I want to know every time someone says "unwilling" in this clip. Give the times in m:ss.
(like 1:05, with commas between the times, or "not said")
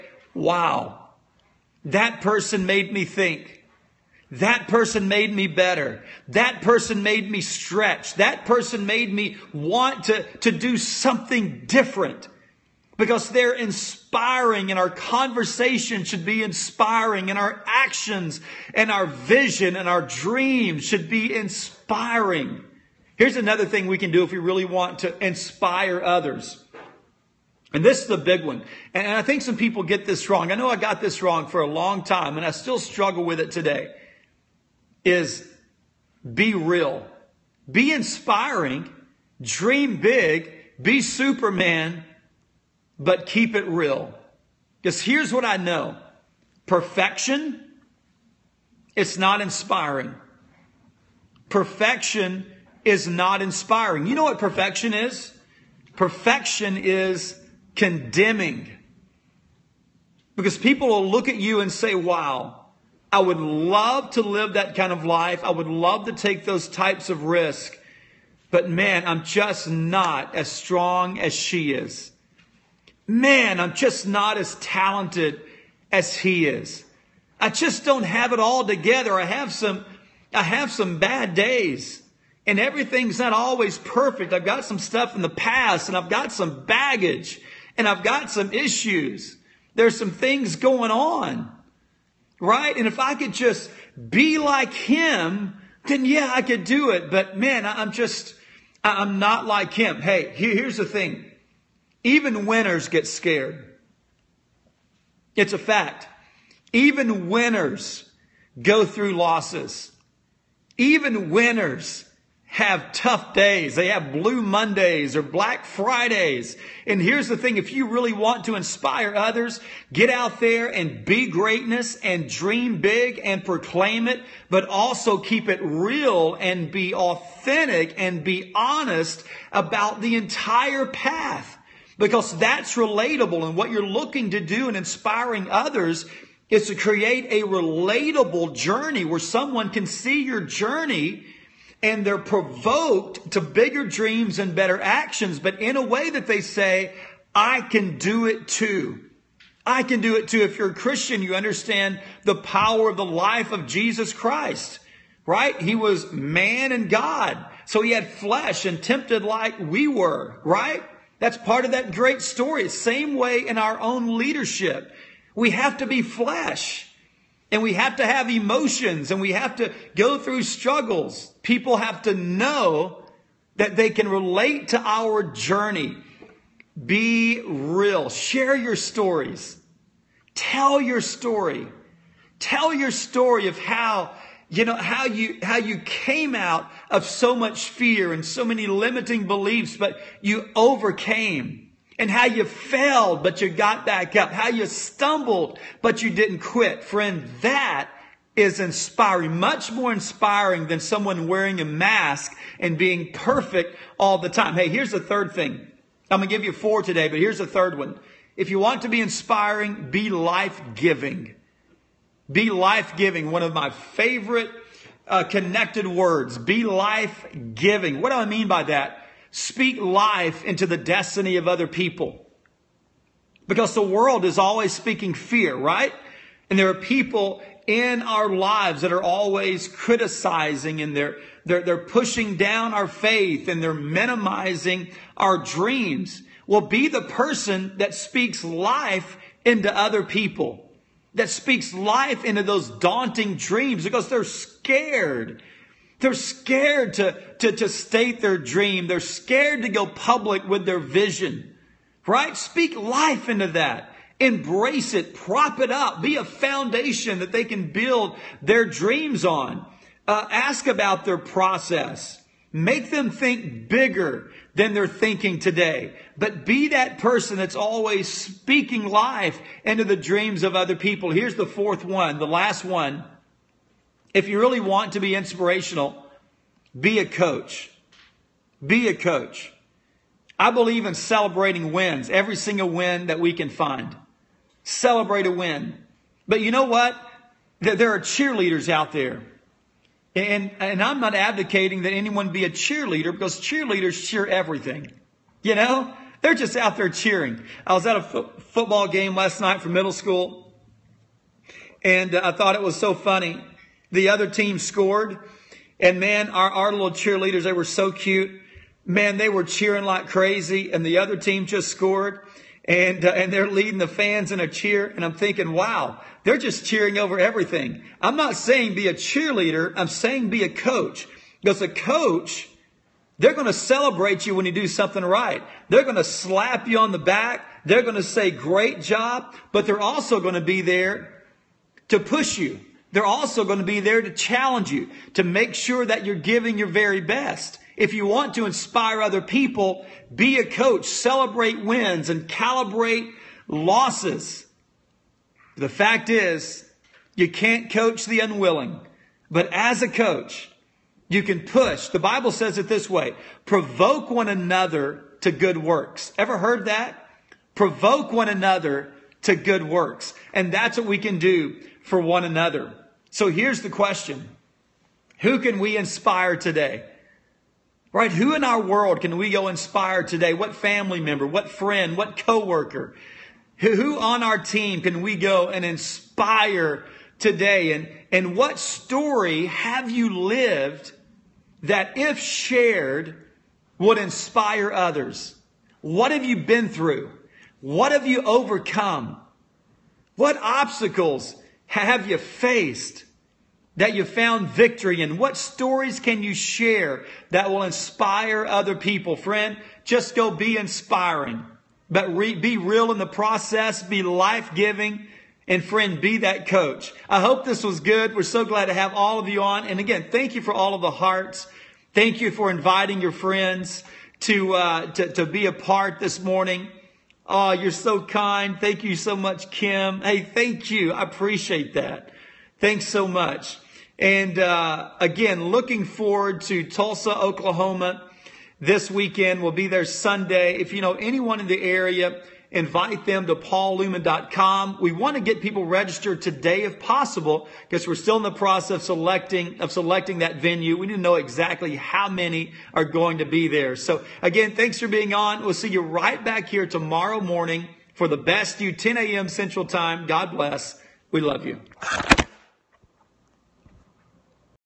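5:48.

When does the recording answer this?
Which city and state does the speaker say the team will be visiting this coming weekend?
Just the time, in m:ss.
7:06.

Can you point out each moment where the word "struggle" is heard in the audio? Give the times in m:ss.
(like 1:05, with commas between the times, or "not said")
0:32, 2:50.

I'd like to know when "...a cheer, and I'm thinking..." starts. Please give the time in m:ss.
5:14.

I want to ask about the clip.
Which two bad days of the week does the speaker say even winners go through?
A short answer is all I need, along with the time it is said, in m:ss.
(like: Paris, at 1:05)
Blue Mondays or Black Fridays, at 1:54.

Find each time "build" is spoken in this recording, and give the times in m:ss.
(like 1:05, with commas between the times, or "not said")
4:17.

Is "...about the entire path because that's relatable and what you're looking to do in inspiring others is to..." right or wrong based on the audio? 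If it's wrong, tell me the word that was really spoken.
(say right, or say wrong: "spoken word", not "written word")
right.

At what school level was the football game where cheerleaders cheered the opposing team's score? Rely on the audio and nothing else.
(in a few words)
Middle school.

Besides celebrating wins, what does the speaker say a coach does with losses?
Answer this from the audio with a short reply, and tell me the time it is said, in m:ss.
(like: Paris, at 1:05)
Calibrate losses, at 5:42.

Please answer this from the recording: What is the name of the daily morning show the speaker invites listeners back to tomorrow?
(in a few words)
The Best You.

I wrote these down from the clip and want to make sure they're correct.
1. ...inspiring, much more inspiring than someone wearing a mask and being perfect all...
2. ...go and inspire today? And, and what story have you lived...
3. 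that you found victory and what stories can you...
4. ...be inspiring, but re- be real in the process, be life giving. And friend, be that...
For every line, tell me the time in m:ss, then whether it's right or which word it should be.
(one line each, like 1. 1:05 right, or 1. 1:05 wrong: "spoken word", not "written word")
1. 3:18 right
2. 6:15 right
3. 6:33 right
4. 6:40 right.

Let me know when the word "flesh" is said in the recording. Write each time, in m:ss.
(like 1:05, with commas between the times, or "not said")
2:38, 2:46.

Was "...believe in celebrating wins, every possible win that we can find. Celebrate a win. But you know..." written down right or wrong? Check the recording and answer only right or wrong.
wrong.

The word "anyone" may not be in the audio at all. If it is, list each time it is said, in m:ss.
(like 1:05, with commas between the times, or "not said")
4:51, 7:10.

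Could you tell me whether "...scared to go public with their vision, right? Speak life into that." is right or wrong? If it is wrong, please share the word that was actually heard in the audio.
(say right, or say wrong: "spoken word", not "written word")
right.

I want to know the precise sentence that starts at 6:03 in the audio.
So here's the question Who can we inspire today?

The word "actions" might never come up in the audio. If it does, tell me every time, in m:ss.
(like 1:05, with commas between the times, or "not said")
0:17, 2:24.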